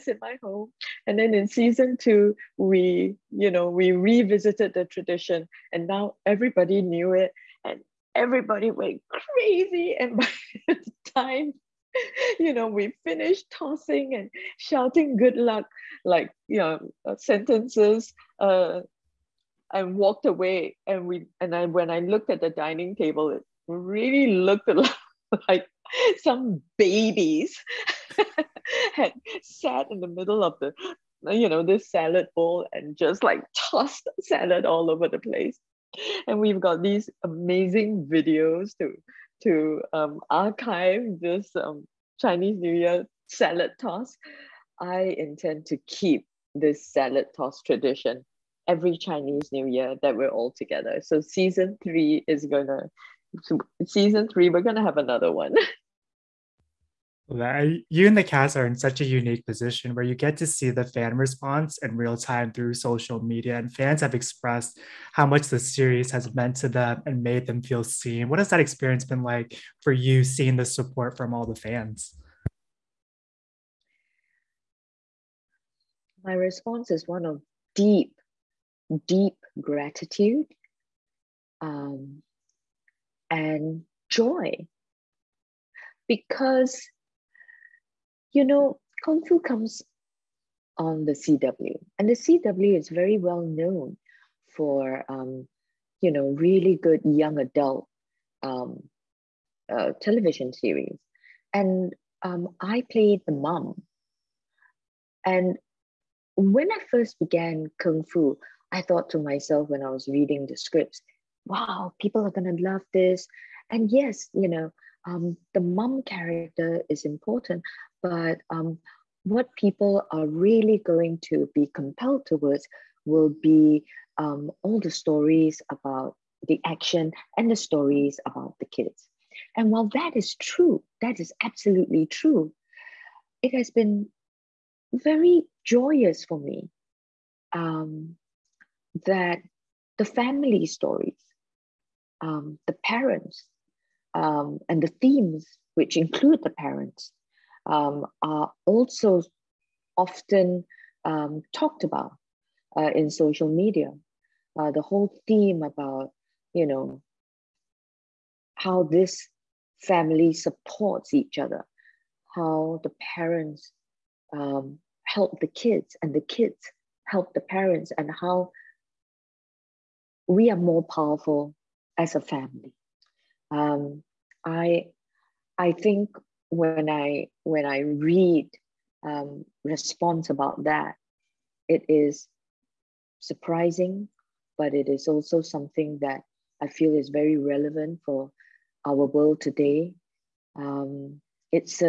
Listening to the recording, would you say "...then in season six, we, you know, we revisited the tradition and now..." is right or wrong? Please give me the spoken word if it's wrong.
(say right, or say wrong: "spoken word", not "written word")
wrong: "two", not "six".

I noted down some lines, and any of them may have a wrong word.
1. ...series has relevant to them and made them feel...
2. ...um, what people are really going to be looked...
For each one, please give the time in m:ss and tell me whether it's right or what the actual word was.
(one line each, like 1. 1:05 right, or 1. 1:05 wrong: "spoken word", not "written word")
1. 1:05 wrong: "meant", not "relevant"
2. 1:58 wrong: "compelled", not "looked".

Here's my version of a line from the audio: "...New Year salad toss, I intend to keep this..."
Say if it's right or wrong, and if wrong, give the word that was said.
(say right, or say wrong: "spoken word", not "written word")
right.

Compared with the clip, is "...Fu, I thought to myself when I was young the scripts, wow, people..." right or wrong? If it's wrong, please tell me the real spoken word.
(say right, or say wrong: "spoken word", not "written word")
wrong: "reading", not "young".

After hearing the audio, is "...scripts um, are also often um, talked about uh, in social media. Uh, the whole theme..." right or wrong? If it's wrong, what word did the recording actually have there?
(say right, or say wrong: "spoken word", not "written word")
wrong: "parents", not "scripts".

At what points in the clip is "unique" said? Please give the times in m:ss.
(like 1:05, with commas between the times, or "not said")
0:59.